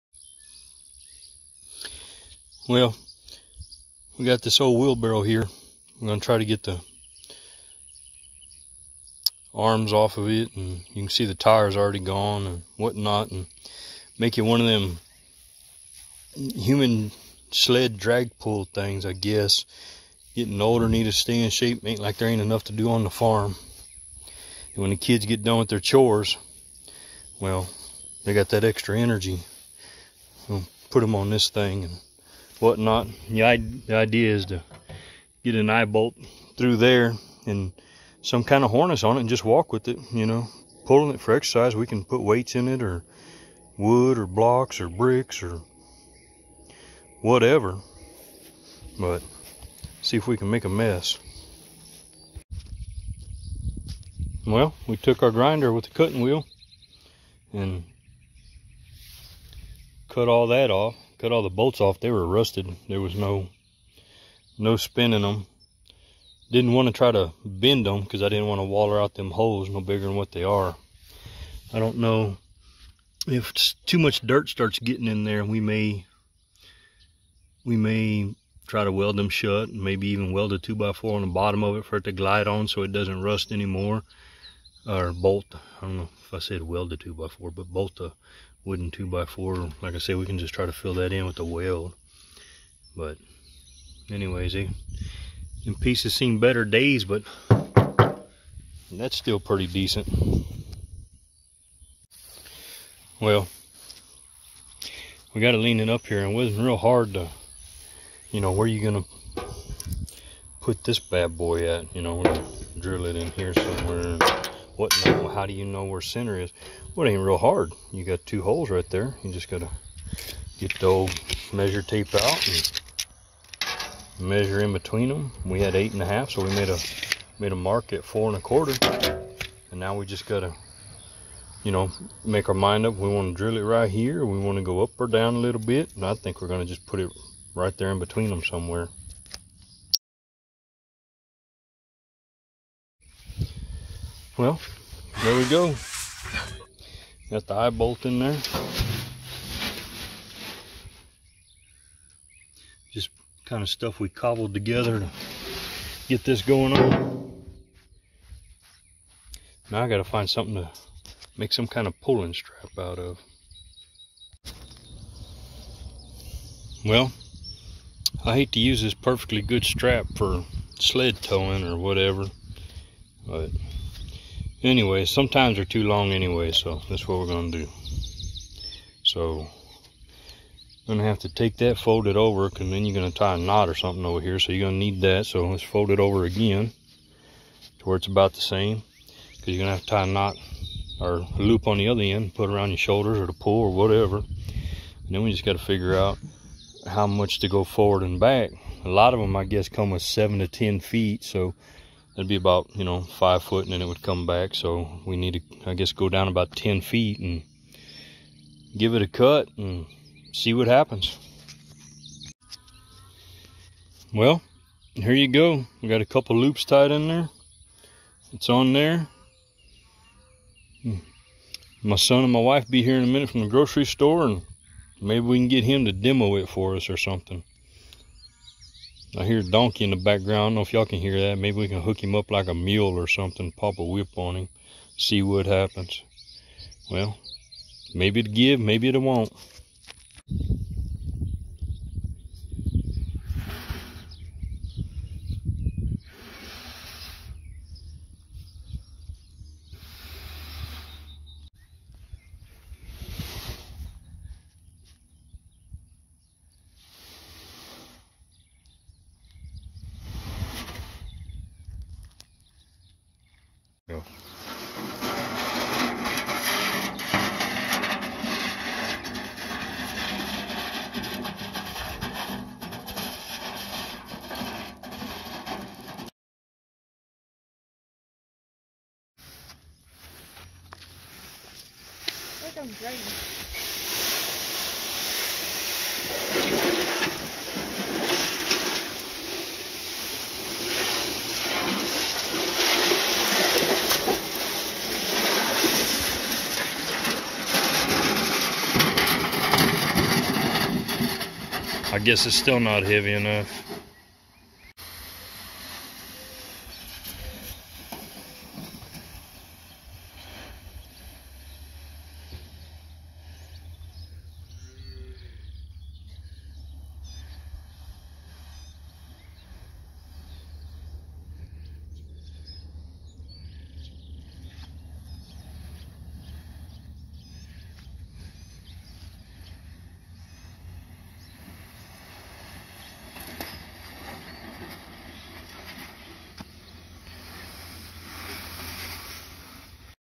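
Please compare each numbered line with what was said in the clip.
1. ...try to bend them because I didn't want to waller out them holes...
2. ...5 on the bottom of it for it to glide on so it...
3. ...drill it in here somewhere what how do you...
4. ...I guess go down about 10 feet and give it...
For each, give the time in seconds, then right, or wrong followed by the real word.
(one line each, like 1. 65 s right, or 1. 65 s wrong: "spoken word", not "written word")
1. 66 s right
2. 80 s wrong: "4", not "5"
3. 112 s right
4. 205 s right.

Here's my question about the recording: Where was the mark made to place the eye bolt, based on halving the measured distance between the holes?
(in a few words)
4 and a quarter.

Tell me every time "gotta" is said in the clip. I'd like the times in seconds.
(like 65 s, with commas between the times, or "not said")
119 s, 130 s, 159 s.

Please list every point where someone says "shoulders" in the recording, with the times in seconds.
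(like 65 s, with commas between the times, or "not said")
192 s.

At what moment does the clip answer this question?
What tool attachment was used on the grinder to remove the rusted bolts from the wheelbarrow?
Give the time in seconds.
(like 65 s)
55 s.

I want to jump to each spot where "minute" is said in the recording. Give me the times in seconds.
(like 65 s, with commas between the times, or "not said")
223 s.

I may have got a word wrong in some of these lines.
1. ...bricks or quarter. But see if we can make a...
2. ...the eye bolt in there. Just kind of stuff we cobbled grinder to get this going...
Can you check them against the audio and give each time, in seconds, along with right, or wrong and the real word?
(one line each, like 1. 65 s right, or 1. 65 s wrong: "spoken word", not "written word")
1. 44 s wrong: "whatever", not "quarter"
2. 147 s wrong: "together", not "grinder".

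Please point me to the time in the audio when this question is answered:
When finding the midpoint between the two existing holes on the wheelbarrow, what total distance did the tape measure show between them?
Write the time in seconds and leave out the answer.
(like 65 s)
125 s.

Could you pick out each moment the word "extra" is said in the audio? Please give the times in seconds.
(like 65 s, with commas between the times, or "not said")
28 s.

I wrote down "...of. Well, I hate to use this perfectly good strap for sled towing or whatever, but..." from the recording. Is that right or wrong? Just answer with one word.
right.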